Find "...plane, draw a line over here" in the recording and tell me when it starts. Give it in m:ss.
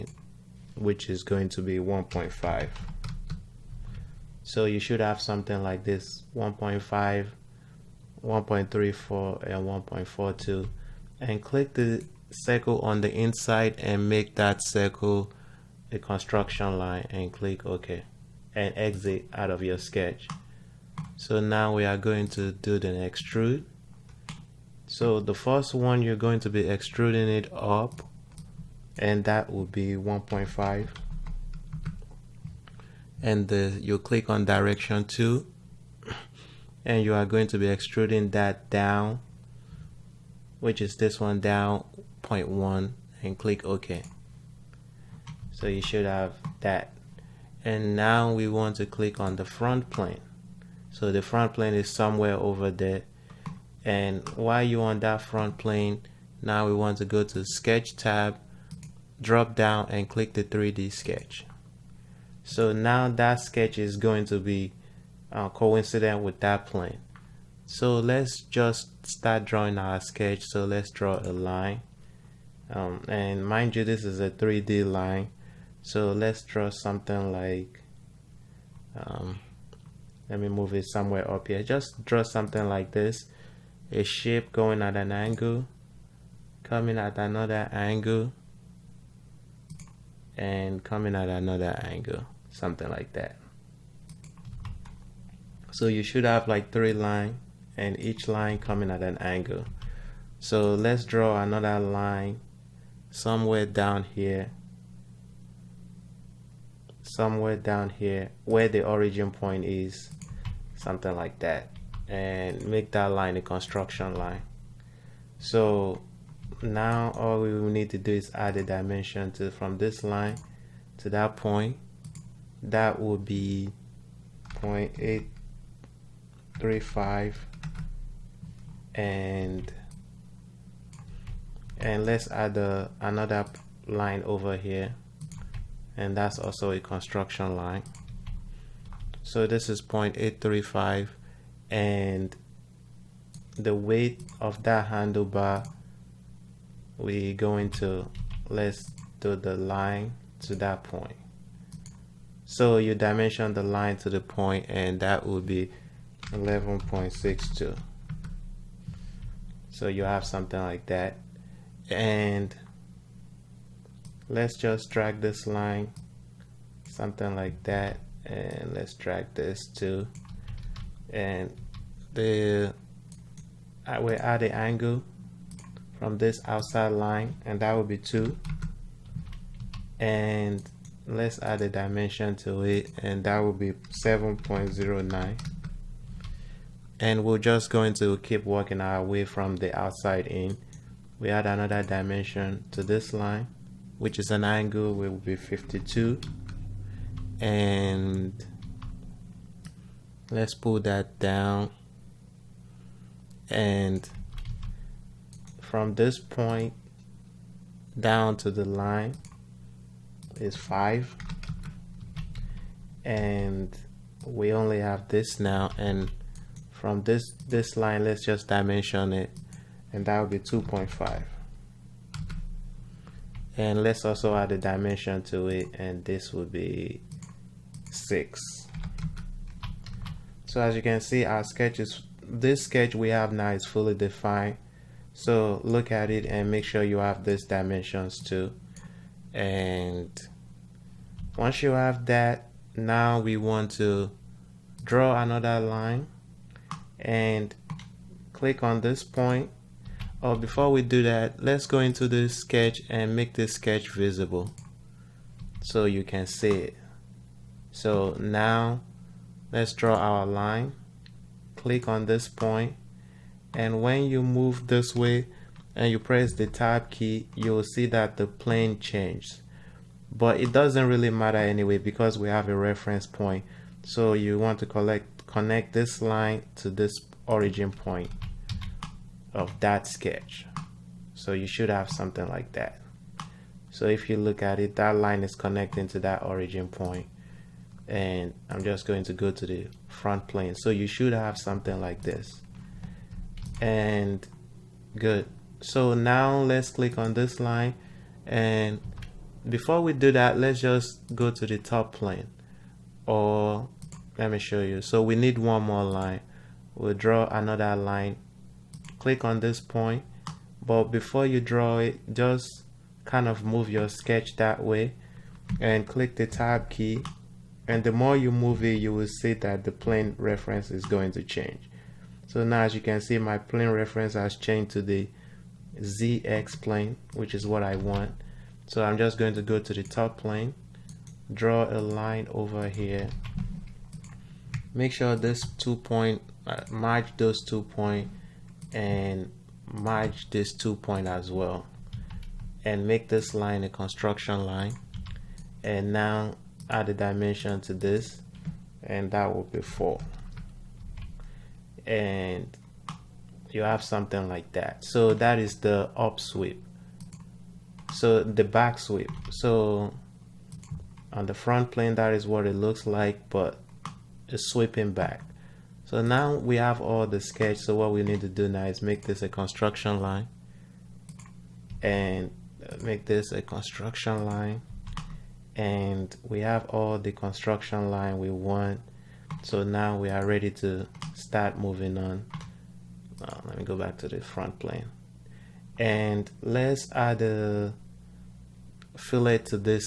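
5:30.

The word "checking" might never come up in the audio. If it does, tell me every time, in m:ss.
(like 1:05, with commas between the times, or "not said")
not said.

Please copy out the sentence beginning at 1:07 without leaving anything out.
So let's just start drawing our sketch.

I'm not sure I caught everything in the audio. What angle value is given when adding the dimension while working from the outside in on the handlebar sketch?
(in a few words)
52.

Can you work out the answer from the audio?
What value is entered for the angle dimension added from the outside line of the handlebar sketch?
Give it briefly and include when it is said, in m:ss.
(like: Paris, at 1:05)
2, at 2:57.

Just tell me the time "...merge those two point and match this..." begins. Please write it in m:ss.
5:36.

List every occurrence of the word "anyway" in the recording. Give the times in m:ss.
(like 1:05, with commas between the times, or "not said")
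4:31.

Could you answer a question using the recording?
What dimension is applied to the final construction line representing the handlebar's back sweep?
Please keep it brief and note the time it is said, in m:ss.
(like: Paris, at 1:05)
4, at 5:49.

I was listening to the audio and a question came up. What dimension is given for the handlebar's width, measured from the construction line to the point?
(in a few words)
11.62.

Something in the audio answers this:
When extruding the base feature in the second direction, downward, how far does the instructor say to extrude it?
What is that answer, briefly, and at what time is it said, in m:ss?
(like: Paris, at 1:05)
0.1, at 0:42.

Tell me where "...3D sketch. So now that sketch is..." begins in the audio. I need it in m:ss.
1:00.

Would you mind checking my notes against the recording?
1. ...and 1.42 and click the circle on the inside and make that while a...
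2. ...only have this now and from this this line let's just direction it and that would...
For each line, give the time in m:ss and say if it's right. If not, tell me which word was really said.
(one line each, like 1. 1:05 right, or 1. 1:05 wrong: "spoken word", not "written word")
1. 0:09 wrong: "circle", not "while"
2. 3:34 wrong: "dimension", not "direction".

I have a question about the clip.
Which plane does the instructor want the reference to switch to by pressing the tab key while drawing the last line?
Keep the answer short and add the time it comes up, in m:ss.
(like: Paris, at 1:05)
ZX plane, at 5:25.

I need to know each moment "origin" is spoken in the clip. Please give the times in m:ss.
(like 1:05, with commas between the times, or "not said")
1:48, 4:37, 4:46.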